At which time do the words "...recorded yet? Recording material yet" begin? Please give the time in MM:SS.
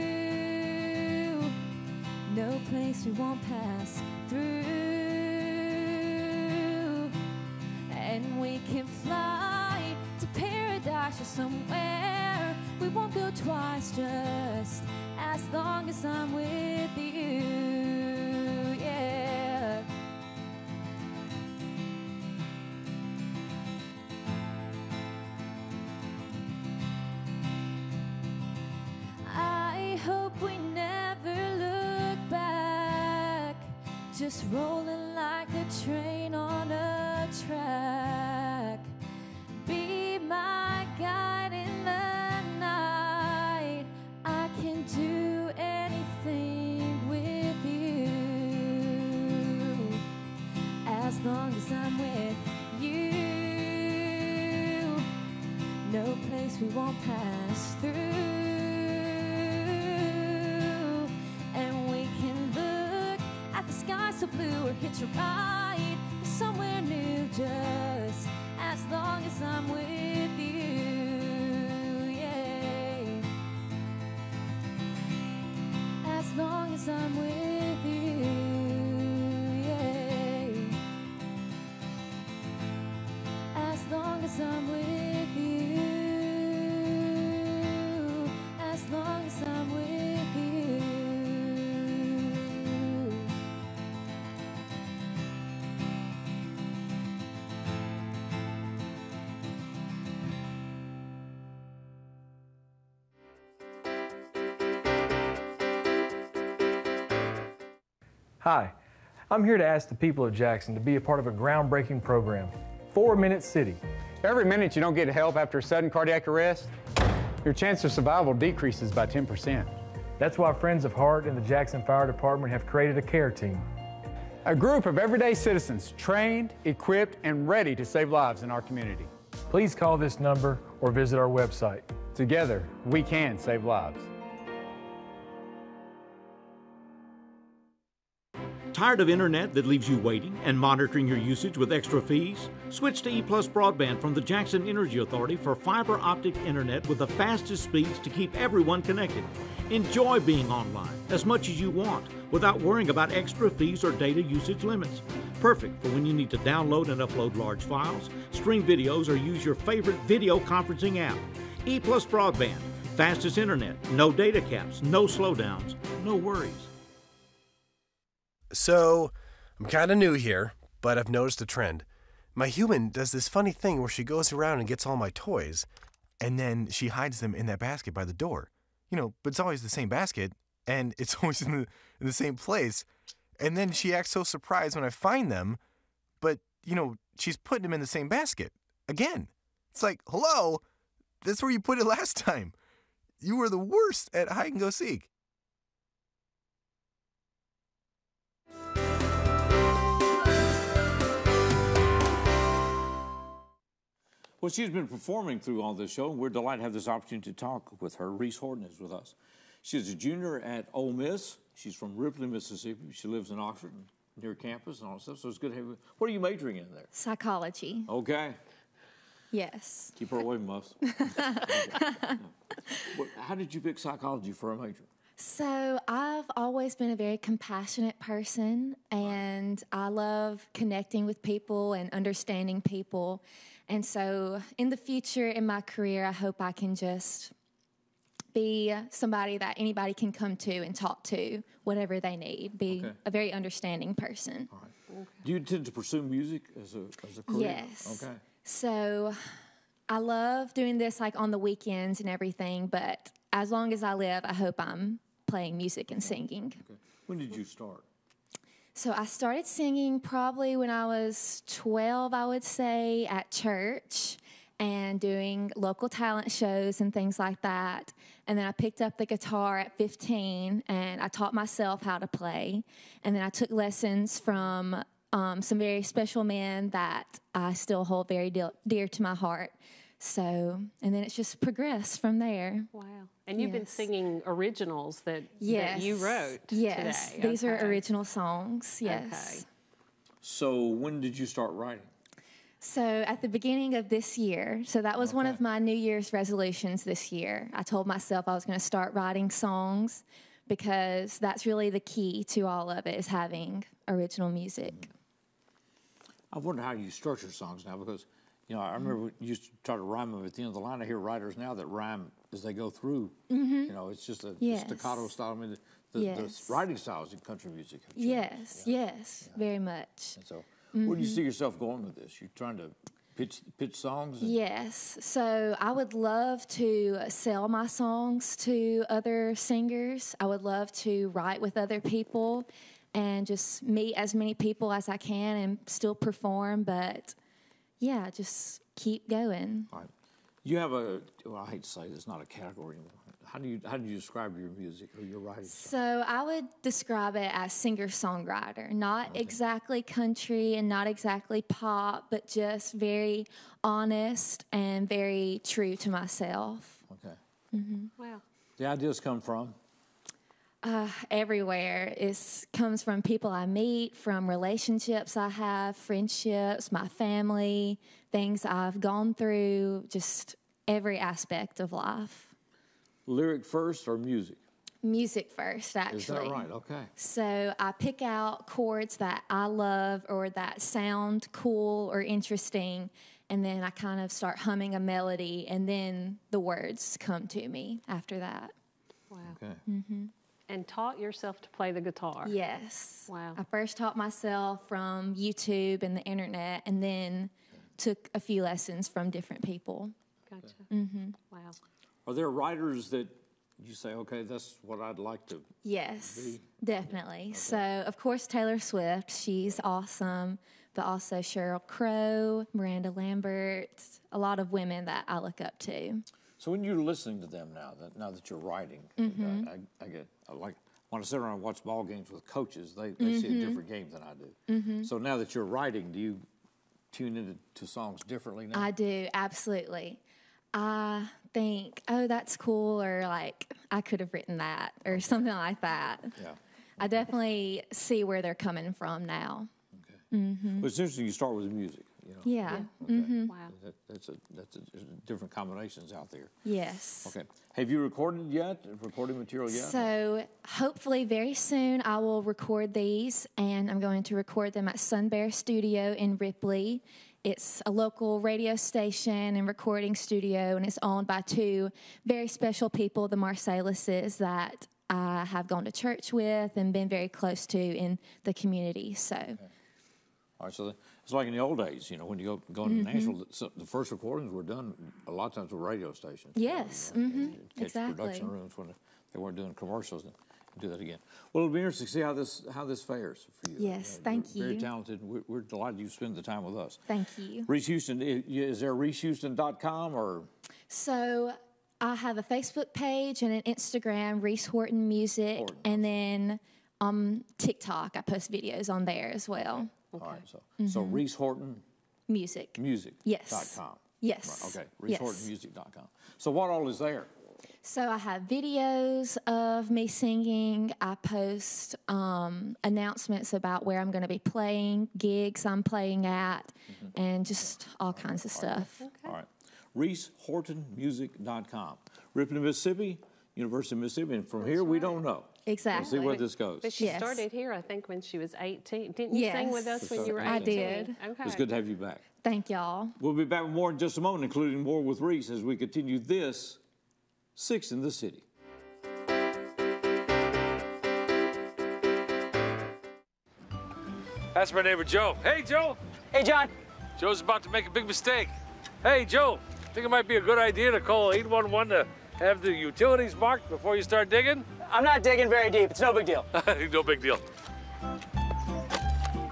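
07:27.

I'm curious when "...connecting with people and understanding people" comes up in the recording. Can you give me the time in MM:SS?
03:50.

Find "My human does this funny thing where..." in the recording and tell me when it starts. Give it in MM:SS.
02:52.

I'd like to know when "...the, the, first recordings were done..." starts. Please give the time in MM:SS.
07:53.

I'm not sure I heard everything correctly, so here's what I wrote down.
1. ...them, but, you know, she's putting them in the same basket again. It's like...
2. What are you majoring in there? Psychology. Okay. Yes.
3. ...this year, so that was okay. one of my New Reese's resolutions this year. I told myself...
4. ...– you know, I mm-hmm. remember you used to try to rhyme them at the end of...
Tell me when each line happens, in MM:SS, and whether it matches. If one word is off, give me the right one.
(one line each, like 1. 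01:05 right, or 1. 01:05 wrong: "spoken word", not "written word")
1. 03:05 right
2. 03:35 right
3. 04:53 wrong: "Year", not "Reese"
4. 05:08 right.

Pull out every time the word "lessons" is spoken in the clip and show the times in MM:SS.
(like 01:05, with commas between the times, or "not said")
04:33, 06:38.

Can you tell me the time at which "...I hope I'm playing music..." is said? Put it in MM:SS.
04:14.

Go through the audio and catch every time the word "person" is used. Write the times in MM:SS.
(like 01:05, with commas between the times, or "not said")
03:47, 04:03.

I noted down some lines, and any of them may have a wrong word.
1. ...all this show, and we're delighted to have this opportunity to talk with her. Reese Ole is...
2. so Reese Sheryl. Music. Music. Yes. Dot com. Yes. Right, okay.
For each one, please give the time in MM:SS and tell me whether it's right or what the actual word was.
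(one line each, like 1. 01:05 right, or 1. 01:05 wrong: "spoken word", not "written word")
1. 03:25 wrong: "Horton", not "Ole"
2. 08:20 wrong: "Horton", not "Sheryl".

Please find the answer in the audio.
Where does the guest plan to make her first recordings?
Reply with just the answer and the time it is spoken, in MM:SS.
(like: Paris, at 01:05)
Sun Bear Studio, at 07:34.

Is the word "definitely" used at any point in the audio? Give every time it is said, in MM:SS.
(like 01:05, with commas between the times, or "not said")
06:46, 07:16.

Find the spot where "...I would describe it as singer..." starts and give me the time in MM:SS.
05:46.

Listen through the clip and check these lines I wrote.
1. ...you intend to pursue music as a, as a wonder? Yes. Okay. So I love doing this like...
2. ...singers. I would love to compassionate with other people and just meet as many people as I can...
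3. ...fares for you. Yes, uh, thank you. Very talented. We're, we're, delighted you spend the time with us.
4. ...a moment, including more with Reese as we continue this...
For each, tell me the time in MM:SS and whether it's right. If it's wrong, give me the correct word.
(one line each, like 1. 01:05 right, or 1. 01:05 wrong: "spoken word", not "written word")
1. 04:05 wrong: "career", not "wonder"
2. 05:29 wrong: "write", not "compassionate"
3. 08:02 right
4. 08:53 right.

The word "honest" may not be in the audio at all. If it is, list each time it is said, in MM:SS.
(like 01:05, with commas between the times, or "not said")
05:53.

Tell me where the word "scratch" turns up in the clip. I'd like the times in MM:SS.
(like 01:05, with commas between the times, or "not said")
not said.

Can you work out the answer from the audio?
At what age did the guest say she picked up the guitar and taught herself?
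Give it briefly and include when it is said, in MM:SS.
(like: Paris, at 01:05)
15, at 04:29.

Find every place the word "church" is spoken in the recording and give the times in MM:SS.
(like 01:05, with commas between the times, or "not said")
04:23, 07:45.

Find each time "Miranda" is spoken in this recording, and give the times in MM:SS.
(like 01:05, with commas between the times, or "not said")
06:52.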